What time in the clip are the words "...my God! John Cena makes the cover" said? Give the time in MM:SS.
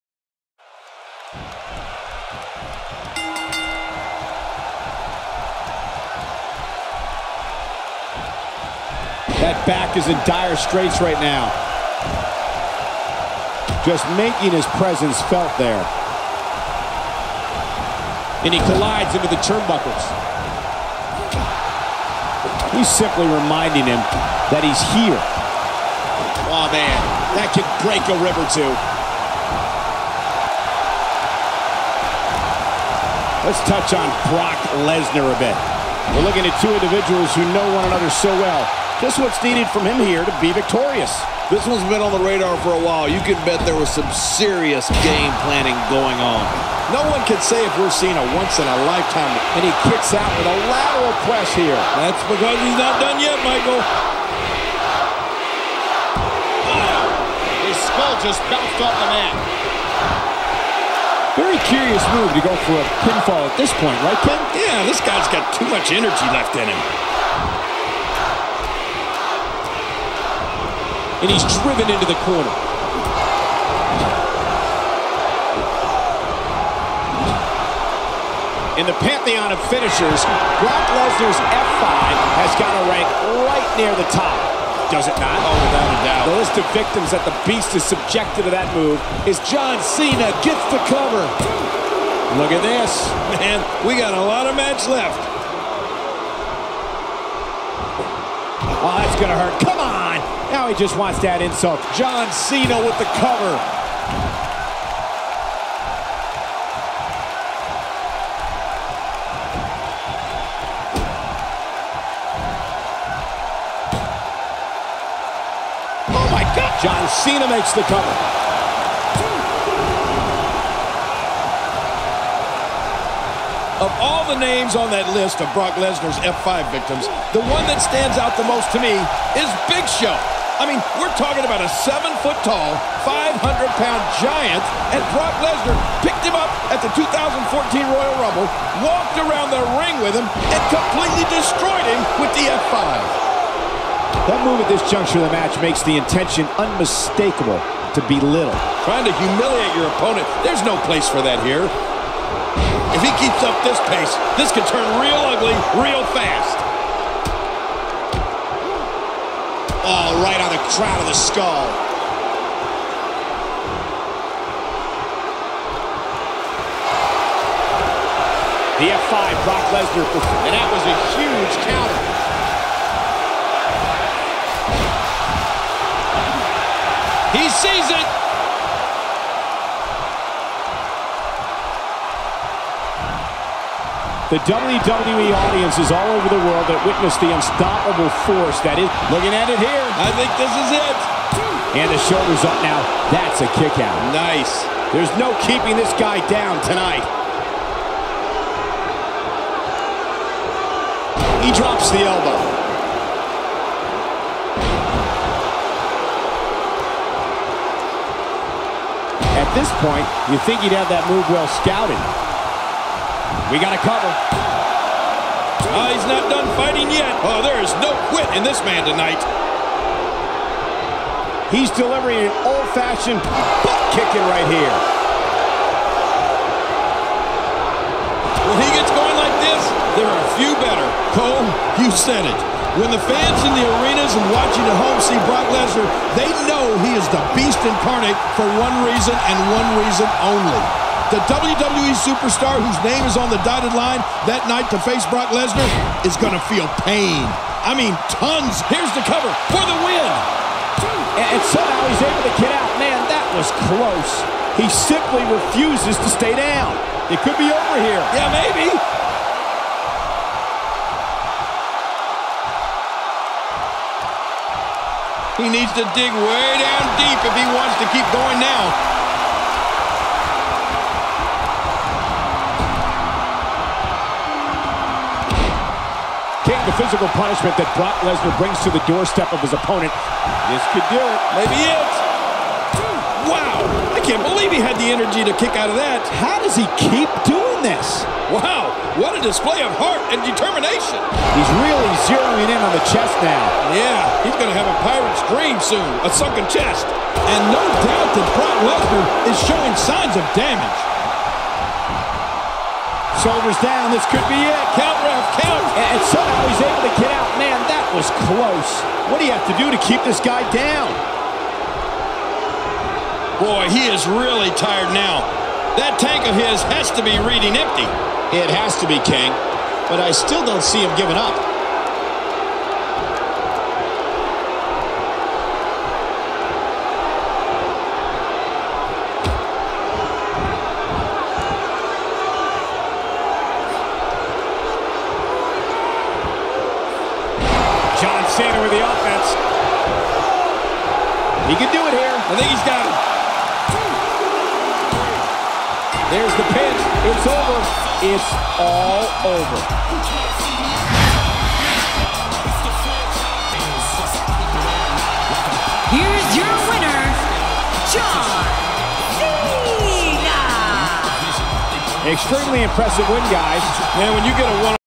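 01:56.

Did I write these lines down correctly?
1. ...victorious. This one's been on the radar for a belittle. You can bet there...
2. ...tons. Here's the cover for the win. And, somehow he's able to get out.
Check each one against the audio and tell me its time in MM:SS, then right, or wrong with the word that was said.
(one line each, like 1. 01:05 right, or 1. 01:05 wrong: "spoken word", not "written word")
1. 00:40 wrong: "while", not "belittle"
2. 04:08 right.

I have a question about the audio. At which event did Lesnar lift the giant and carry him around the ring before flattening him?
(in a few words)
2014 Royal Rumble.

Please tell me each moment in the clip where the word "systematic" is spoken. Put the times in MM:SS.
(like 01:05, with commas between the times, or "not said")
not said.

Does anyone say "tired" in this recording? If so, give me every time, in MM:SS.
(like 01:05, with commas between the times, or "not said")
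05:14.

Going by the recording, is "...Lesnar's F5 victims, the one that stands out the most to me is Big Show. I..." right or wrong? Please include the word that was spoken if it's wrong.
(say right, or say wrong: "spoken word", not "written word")
right.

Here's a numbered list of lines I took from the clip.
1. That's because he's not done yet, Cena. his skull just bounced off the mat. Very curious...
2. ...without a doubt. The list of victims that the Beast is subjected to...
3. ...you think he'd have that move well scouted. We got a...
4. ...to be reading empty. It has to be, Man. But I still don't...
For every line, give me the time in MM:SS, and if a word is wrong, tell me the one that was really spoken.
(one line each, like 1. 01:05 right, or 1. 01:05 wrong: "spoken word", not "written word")
1. 00:51 wrong: "Michael", not "Cena"
2. 01:25 right
3. 03:30 right
4. 05:16 wrong: "King", not "Man".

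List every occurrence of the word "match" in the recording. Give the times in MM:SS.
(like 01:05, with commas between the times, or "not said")
01:34, 02:25.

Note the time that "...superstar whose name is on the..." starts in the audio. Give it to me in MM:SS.
04:01.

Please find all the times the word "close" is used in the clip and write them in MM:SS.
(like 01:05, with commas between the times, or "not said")
04:13, 05:08.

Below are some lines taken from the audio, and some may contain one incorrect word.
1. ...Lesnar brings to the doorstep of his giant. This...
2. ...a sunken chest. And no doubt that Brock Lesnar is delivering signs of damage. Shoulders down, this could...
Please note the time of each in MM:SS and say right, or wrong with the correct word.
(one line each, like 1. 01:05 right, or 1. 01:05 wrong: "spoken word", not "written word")
1. 04:38 wrong: "opponent", not "giant"
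2. 04:56 wrong: "showing", not "delivering".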